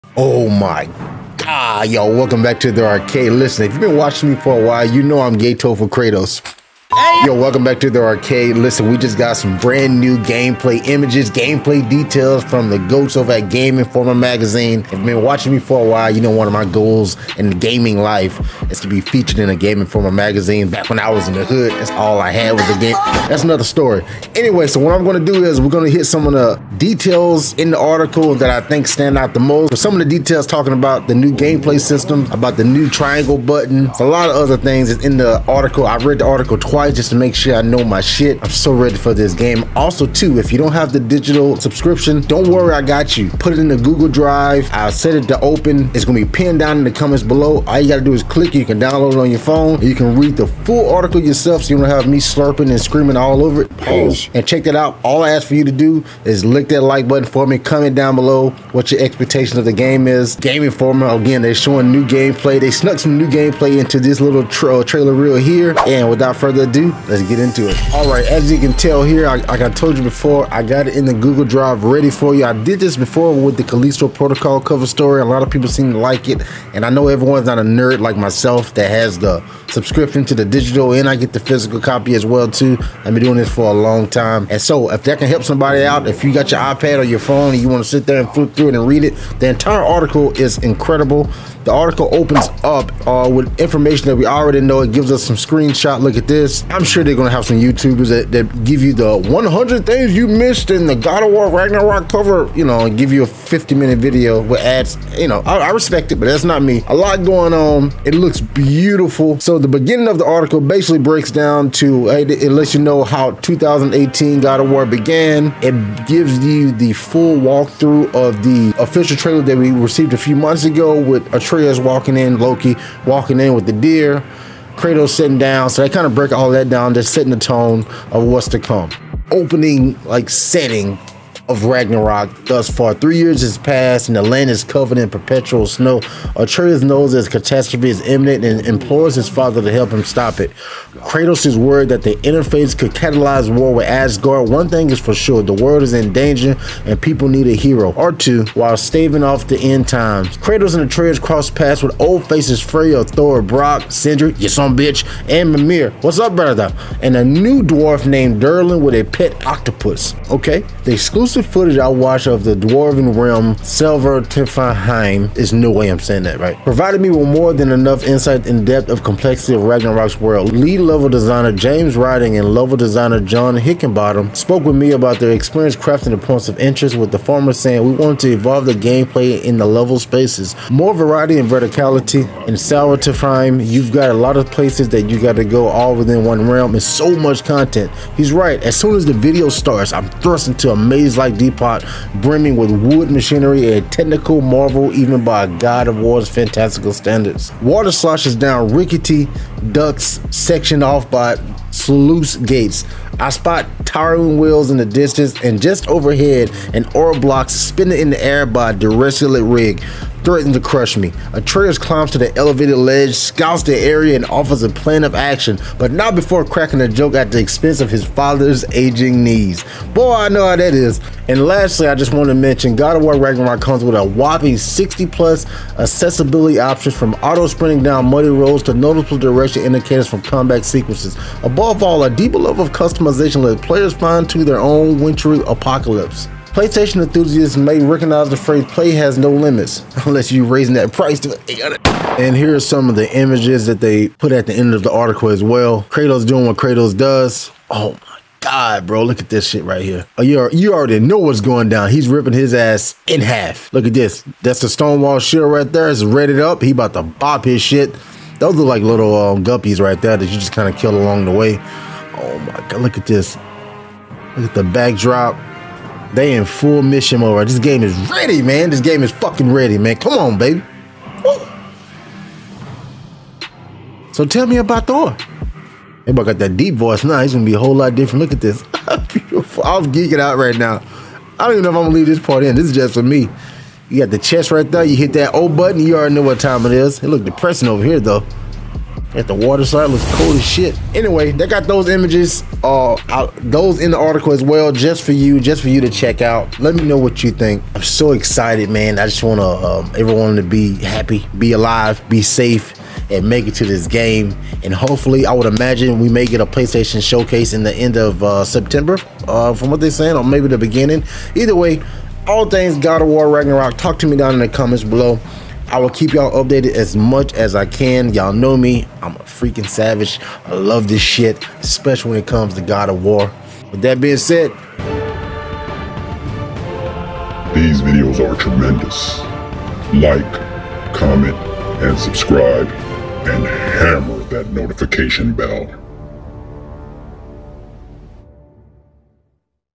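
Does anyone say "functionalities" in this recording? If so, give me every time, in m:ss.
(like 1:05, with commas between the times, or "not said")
not said.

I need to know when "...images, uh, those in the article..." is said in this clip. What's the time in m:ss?
4:51.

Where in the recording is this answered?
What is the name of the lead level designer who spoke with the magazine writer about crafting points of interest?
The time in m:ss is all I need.
2:51.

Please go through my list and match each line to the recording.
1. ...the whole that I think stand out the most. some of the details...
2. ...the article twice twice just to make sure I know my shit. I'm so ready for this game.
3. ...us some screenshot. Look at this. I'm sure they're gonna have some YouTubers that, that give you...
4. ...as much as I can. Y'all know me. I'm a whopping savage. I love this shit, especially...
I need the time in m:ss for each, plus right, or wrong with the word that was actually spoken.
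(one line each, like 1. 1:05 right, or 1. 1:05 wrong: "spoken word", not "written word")
1. 0:27 wrong: "article", not "whole"
2. 0:36 right
3. 1:35 right
4. 5:16 wrong: "freaking", not "whopping".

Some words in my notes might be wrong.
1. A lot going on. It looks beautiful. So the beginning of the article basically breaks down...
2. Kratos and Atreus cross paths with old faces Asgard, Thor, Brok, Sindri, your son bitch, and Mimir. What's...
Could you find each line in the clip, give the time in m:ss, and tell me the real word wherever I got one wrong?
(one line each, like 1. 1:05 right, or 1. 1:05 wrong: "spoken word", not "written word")
1. 1:46 right
2. 2:30 wrong: "Freya", not "Asgard".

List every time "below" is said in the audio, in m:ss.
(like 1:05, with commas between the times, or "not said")
0:47, 0:58, 5:14.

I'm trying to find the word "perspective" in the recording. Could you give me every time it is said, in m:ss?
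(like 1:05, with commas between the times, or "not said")
not said.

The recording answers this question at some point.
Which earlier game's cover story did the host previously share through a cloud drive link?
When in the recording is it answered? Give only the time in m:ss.
1:13.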